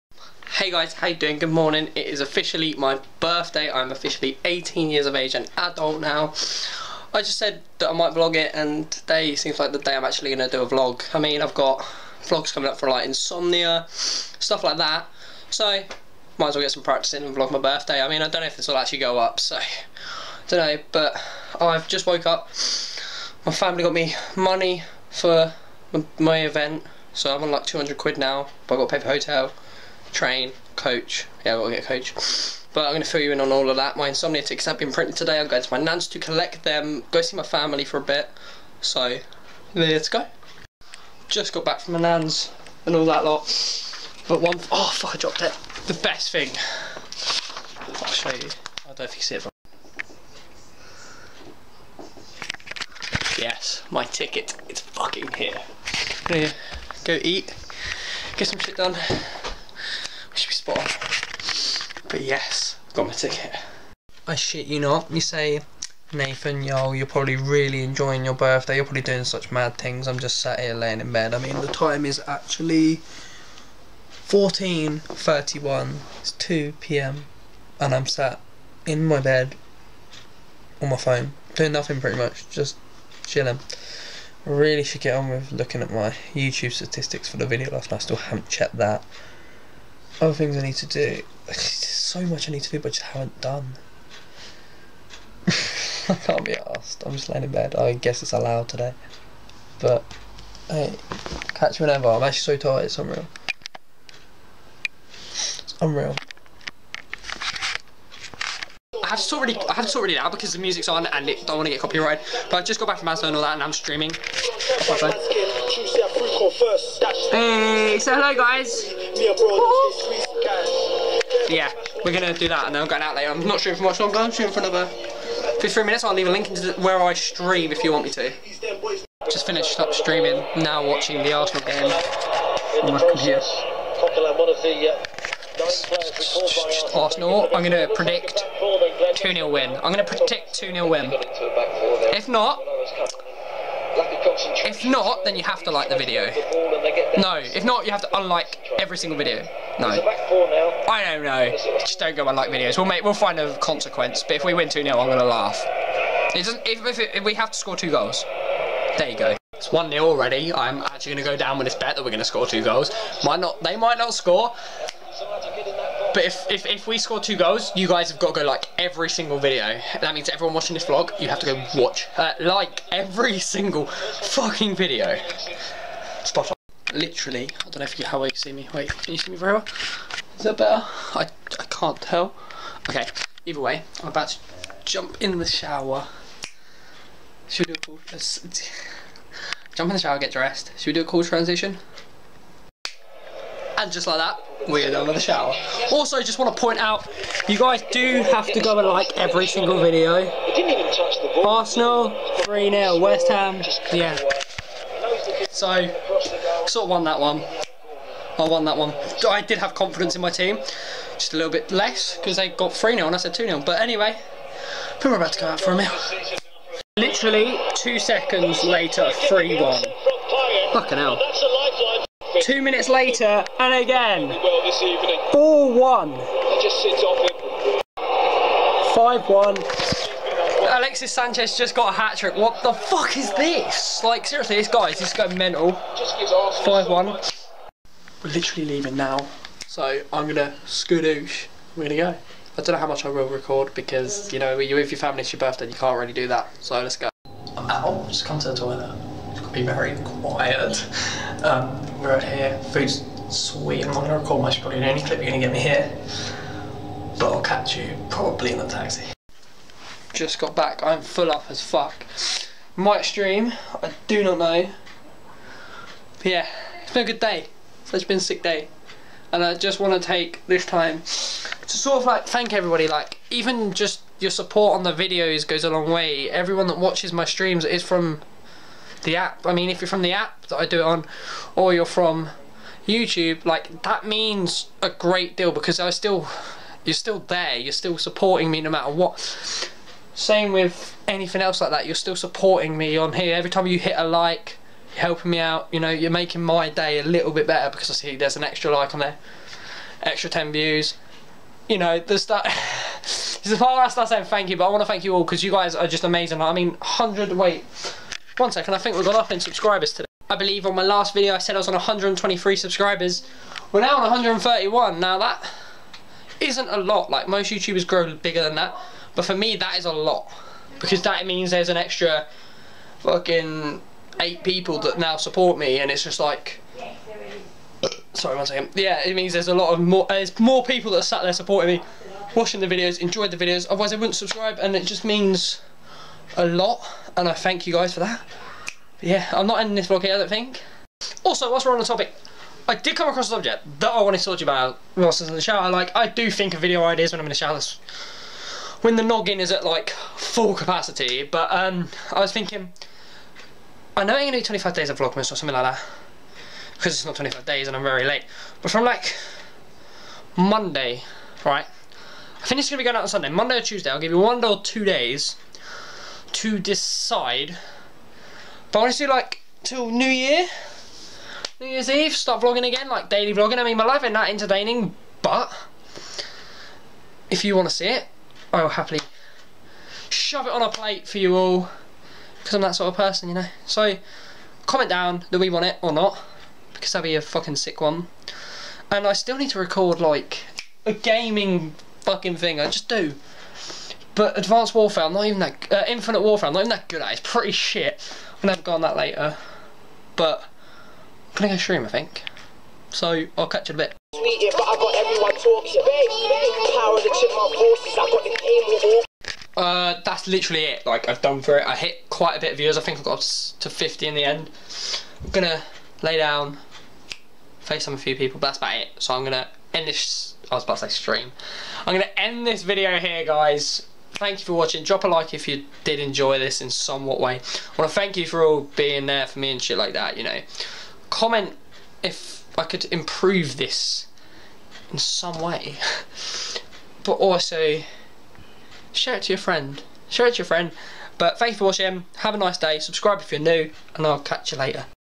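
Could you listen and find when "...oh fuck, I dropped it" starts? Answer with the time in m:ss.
0:44.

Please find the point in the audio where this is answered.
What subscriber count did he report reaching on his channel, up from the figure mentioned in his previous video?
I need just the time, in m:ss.
5:14.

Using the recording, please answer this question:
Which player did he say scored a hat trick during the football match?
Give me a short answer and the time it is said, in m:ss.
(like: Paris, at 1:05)
Alexis Sanchez, at 3:50.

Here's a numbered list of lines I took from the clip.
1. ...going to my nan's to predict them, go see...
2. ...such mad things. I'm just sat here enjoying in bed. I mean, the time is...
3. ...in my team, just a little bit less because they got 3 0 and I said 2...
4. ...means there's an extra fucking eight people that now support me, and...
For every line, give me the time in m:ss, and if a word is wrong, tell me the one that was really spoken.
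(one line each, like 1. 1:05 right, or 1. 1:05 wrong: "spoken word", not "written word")
1. 0:35 wrong: "collect", not "predict"
2. 1:09 wrong: "laying", not "enjoying"
3. 3:30 right
4. 5:21 right.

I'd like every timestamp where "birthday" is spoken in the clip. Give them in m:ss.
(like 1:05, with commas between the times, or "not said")
0:03, 0:17, 1:08, 4:05.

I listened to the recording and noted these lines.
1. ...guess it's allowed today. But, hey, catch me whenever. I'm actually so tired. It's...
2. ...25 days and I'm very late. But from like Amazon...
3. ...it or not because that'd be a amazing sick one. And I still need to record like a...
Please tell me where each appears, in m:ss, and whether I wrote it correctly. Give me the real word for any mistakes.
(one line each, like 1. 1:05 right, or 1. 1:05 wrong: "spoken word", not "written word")
1. 1:37 right
2. 5:57 wrong: "Monday", not "Amazon"
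3. 6:25 wrong: "fucking", not "amazing".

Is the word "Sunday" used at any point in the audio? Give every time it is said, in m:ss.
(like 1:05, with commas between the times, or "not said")
6:03.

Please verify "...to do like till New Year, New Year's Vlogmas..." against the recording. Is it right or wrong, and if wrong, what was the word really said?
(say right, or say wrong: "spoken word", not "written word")
wrong: "Eve", not "Vlogmas".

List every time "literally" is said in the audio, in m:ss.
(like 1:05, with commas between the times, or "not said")
2:56, 3:36, 3:58, 6:50.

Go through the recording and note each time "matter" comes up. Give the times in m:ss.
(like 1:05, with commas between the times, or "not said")
4:48.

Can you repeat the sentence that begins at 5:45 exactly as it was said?
Like, I do think of video ideas when I'm in the shower when the noggin is at like full capacity.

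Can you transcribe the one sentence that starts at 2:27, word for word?
No, if not, you have to unlike every single video.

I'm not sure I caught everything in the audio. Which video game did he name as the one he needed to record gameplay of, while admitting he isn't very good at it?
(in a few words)
Infinite Warfare.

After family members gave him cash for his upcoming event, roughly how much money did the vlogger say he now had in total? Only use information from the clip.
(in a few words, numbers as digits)
200 quid.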